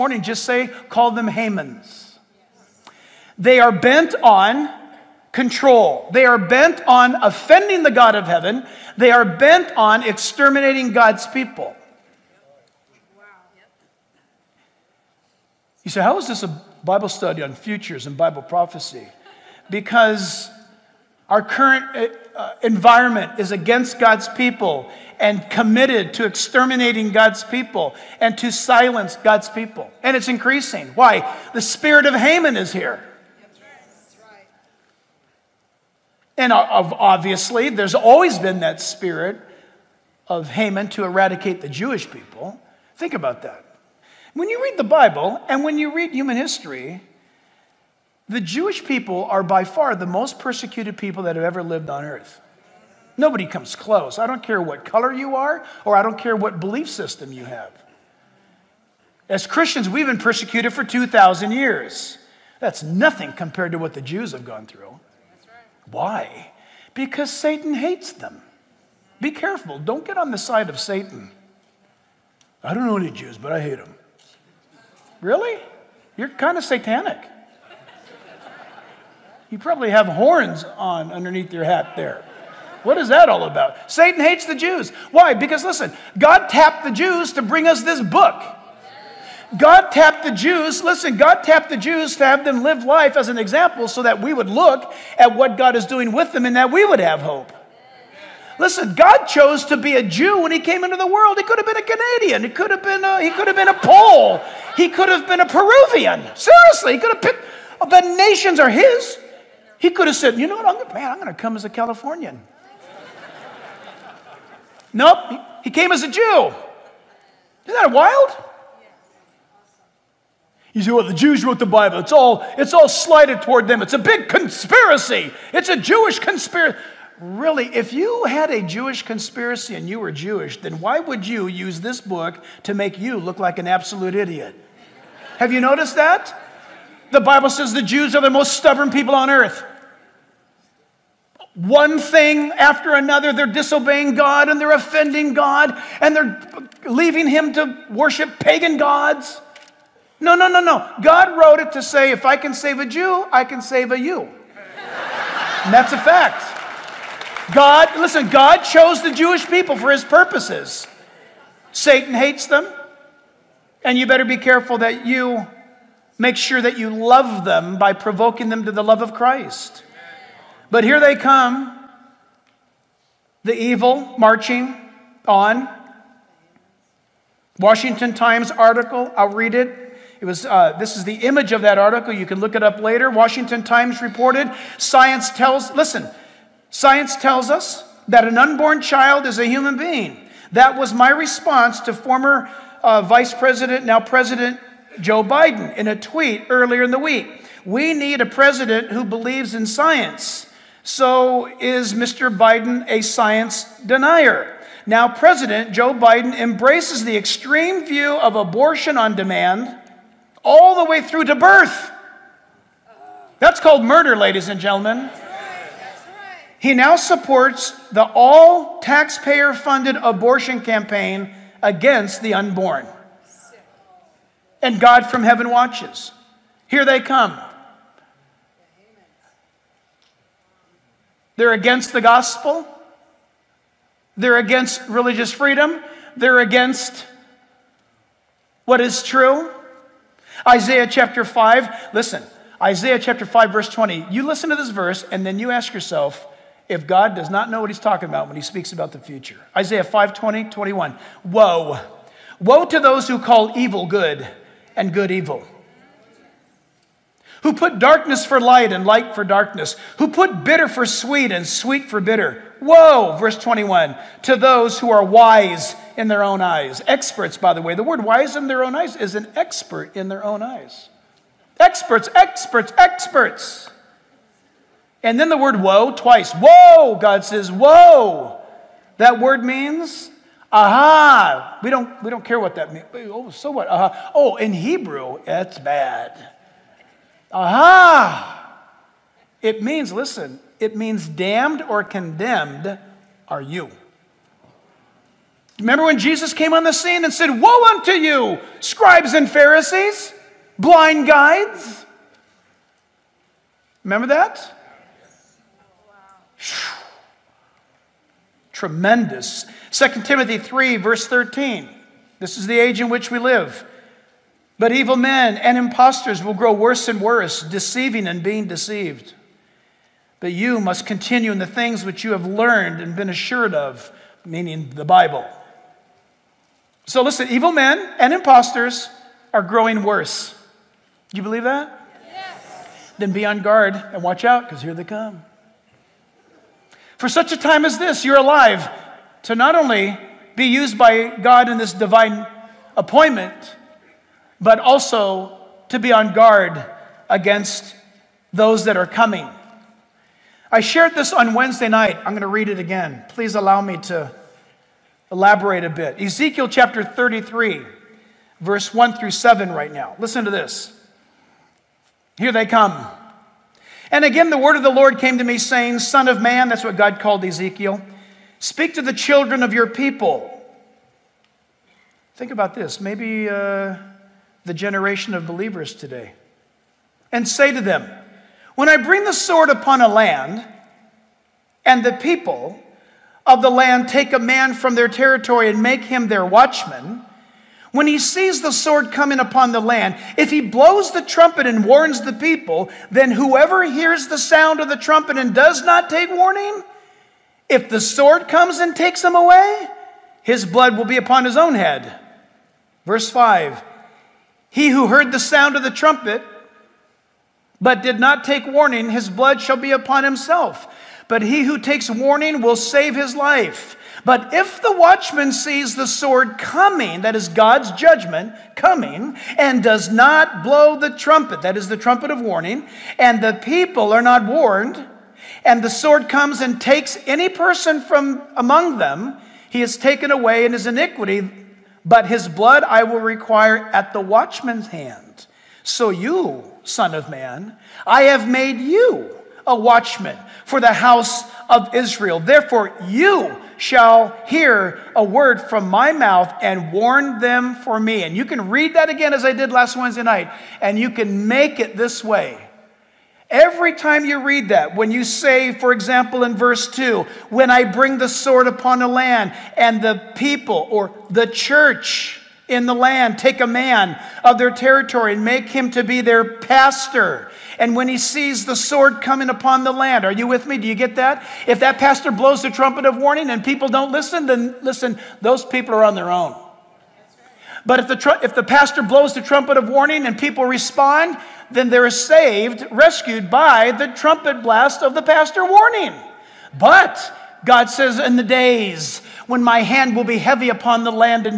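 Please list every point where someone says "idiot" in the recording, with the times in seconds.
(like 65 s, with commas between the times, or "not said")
134 s.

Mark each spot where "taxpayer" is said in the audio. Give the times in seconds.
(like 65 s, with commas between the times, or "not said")
218 s.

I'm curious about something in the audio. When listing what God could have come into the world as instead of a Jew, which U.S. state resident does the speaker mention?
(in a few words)
Californian.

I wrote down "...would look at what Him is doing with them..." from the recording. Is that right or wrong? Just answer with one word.
wrong.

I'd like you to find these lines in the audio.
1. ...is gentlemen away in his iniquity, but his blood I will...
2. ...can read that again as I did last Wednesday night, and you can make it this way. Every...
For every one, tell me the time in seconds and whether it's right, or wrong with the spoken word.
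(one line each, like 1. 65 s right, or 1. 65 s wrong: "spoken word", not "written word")
1. 429 s wrong: "taken", not "gentlemen"
2. 448 s right.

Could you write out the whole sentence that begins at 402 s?
Verse 5 He who heard the sound of the trumpet, but did not take warning, his blood shall be upon himself.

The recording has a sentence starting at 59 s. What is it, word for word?
As Christians, we've been persecuted for 2,000 years.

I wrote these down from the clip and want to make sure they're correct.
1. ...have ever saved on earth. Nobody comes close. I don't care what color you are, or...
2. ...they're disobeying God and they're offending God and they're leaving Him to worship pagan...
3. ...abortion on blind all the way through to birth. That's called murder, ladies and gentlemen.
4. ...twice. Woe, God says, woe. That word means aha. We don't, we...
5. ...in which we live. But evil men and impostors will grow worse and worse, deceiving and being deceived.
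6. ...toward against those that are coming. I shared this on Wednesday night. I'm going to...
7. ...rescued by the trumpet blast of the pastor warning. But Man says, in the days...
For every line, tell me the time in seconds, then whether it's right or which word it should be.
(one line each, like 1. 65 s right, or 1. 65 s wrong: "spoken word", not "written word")
1. 51 s wrong: "lived", not "saved"
2. 143 s right
3. 208 s wrong: "demand", not "blind"
4. 275 s right
5. 312 s right
6. 346 s wrong: "guard", not "toward"
7. 482 s wrong: "God", not "Man".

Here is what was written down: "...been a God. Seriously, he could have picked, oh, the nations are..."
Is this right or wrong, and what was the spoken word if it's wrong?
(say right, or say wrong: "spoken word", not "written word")
wrong: "Peruvian", not "God".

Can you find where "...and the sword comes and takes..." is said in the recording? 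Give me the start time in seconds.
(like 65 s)
425 s.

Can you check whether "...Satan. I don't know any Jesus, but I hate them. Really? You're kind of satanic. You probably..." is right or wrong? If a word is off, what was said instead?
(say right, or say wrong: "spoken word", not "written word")
wrong: "Jews", not "Jesus".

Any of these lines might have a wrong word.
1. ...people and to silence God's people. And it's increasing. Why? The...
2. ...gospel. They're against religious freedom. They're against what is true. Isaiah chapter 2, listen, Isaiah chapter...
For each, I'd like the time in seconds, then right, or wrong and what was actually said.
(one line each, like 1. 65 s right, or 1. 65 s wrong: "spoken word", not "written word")
1. 27 s right
2. 232 s wrong: "5", not "2".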